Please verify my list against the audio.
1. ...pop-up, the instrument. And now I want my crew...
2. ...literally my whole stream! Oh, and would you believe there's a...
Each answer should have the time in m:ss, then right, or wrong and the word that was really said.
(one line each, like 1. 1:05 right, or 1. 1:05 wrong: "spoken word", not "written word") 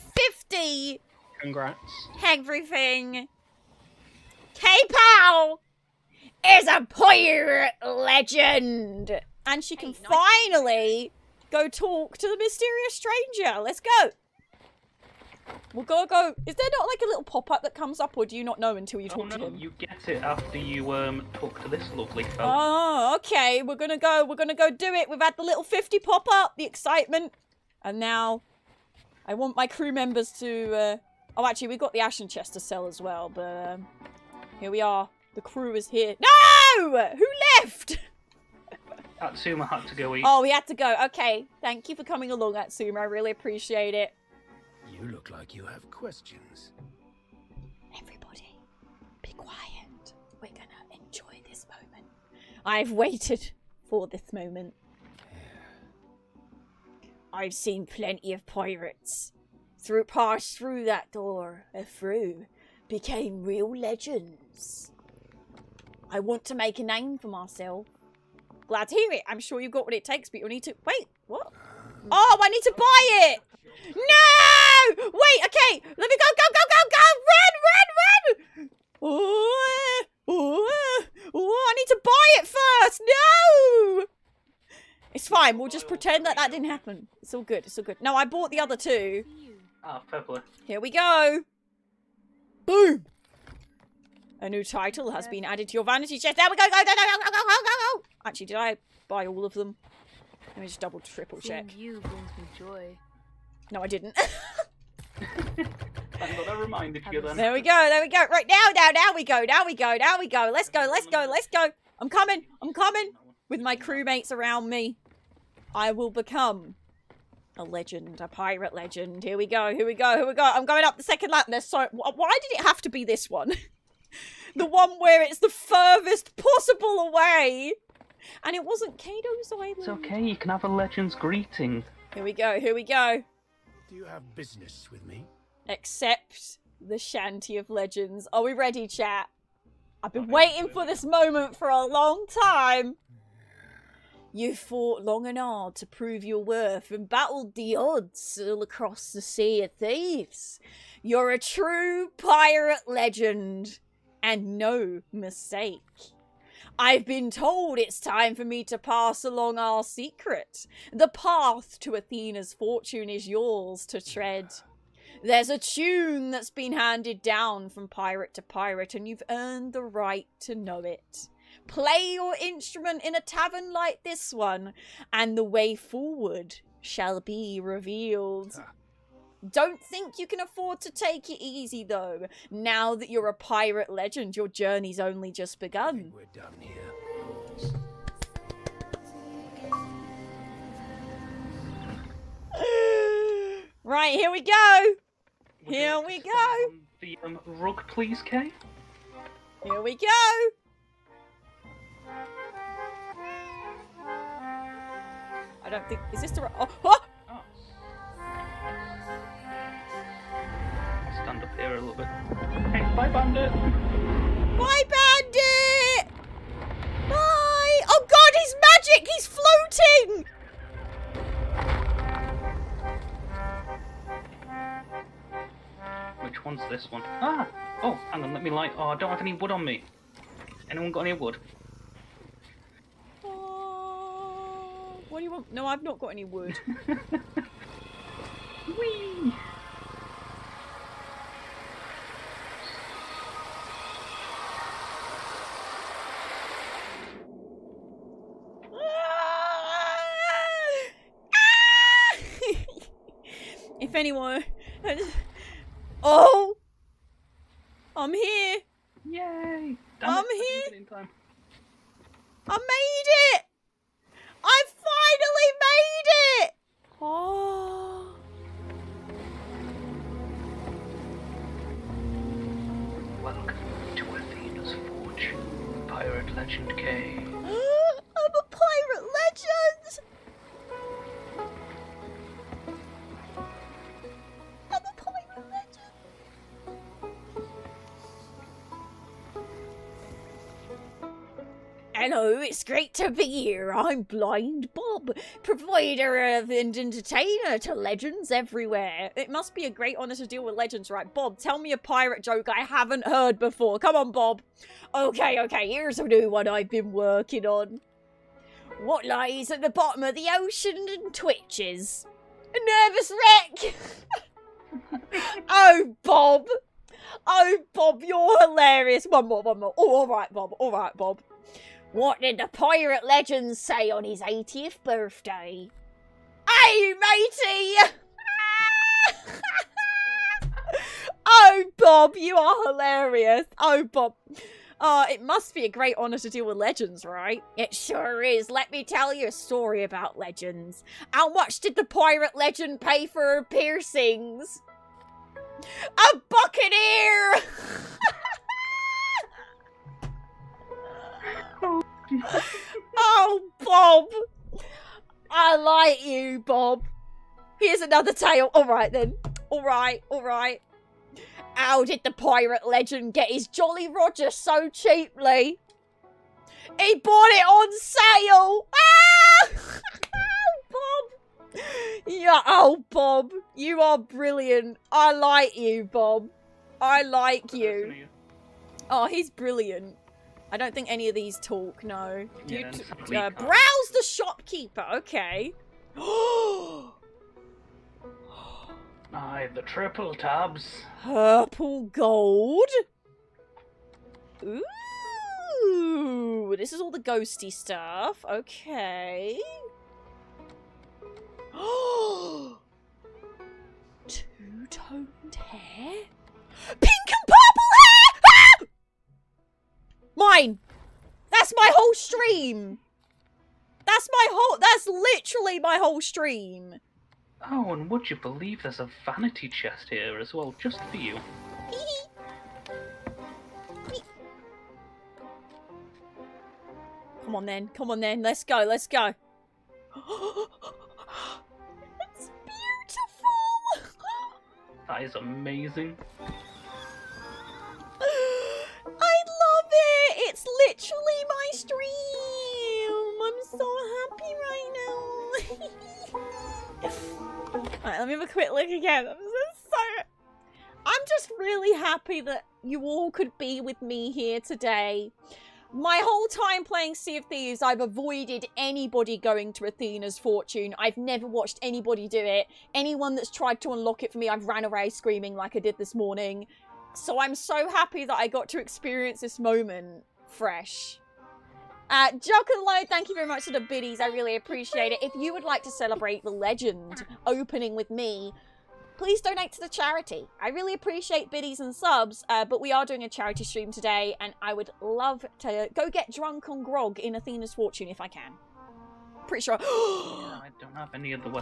1. 0:25 wrong: "excitement", not "instrument"
2. 6:54 right.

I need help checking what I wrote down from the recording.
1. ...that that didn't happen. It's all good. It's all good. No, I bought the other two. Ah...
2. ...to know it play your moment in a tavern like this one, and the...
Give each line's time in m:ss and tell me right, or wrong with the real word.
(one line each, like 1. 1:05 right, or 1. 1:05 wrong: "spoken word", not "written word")
1. 1:26 right
2. 2:50 wrong: "instrument", not "moment".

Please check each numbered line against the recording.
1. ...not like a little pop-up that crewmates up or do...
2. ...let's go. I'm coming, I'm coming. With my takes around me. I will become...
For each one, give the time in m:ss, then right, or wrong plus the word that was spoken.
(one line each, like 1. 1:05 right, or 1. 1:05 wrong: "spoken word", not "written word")
1. 0:16 wrong: "comes", not "crewmates"
2. 1:51 wrong: "crewmates", not "takes".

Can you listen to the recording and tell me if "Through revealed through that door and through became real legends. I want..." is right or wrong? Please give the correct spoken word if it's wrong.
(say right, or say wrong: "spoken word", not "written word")
wrong: "passed", not "revealed".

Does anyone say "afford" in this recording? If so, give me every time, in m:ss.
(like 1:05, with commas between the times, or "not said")
3:00.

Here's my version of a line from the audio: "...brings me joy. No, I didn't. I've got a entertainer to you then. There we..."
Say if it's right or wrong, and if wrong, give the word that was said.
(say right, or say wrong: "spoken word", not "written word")
wrong: "reminder", not "entertainer".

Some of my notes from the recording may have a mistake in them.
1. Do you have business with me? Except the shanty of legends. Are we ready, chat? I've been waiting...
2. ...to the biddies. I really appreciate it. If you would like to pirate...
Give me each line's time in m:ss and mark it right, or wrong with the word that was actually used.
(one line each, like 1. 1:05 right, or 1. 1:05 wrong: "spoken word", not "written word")
1. 2:13 right
2. 7:53 wrong: "celebrate", not "pirate".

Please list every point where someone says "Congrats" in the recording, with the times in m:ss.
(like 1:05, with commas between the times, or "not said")
0:01.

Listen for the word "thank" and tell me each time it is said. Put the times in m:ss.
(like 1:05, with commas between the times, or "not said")
0:41, 7:52.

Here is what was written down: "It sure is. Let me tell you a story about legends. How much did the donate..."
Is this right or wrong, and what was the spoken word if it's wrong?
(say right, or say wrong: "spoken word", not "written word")
wrong: "pirate", not "donate".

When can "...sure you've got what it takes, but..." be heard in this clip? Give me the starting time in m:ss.
1:09.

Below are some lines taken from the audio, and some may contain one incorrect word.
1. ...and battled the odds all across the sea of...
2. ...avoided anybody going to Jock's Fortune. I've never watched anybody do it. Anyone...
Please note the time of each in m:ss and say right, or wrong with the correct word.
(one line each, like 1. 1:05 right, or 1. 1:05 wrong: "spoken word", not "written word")
1. 2:26 right
2. 7:37 wrong: "Athena", not "Jock".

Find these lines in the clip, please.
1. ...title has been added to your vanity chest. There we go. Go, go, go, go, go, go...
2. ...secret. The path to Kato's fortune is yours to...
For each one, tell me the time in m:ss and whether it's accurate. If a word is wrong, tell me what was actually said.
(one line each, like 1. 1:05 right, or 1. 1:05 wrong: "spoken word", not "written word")
1. 1:34 right
2. 2:39 wrong: "Athena", not "Kato".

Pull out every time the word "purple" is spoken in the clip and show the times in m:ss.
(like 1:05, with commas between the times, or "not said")
1:30, 6:31.